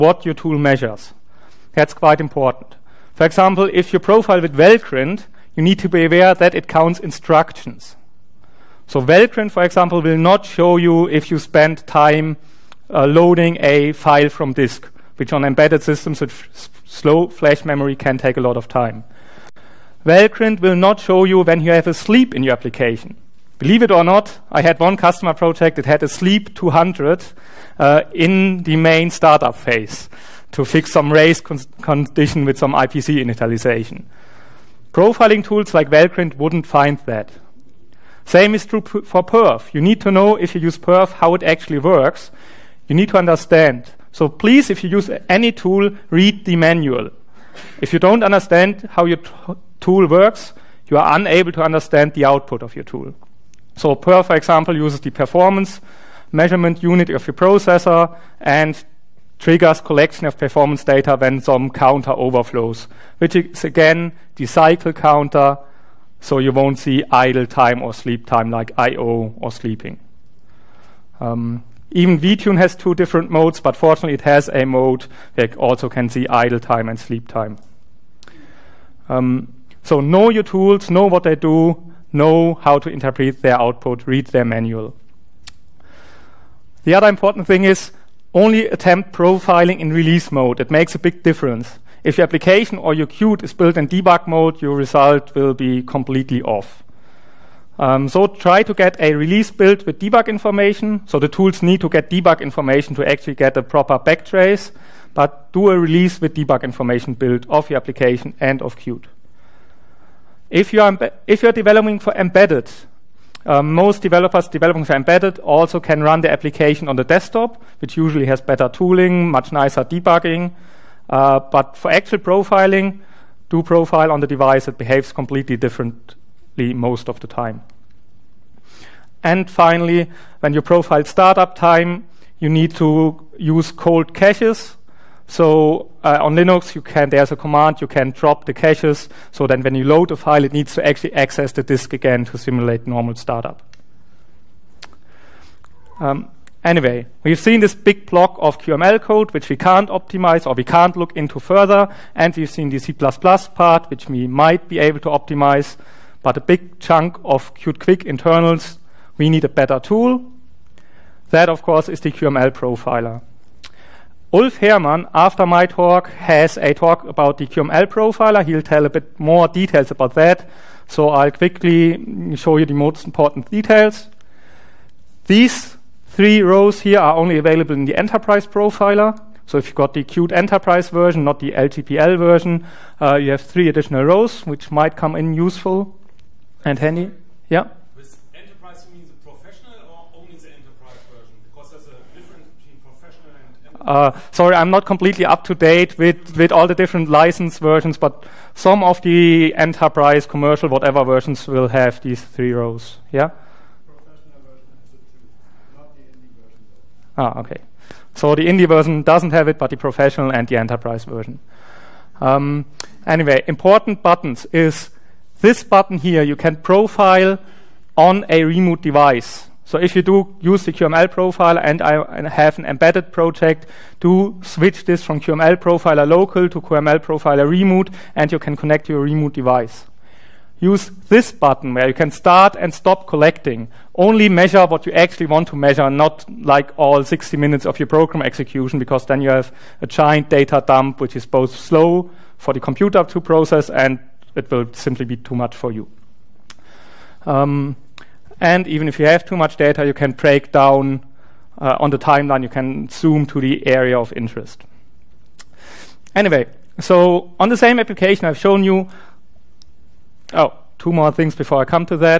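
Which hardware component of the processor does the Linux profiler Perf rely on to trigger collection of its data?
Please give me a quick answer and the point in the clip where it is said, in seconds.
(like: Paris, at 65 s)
performance measurement unit, at 55 s.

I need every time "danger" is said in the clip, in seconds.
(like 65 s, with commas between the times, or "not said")
not said.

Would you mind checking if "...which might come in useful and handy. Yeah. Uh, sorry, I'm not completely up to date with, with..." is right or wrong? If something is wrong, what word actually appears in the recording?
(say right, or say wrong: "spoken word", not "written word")
right.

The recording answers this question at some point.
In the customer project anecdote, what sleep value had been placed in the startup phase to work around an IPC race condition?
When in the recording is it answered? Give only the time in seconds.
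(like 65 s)
26 s.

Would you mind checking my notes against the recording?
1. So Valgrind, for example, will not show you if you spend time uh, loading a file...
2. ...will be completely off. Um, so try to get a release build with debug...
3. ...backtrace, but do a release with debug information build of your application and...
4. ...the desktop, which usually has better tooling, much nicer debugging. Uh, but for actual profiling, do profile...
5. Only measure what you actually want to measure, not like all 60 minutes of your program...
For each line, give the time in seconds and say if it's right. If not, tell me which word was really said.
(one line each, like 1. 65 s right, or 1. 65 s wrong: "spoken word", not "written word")
1. 8 s right
2. 95 s right
3. 103 s right
4. 116 s right
5. 233 s right.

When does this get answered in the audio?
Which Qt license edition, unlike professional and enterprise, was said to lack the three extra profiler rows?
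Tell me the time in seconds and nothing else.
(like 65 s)
208 s.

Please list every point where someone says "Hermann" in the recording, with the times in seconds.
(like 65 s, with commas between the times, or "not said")
164 s.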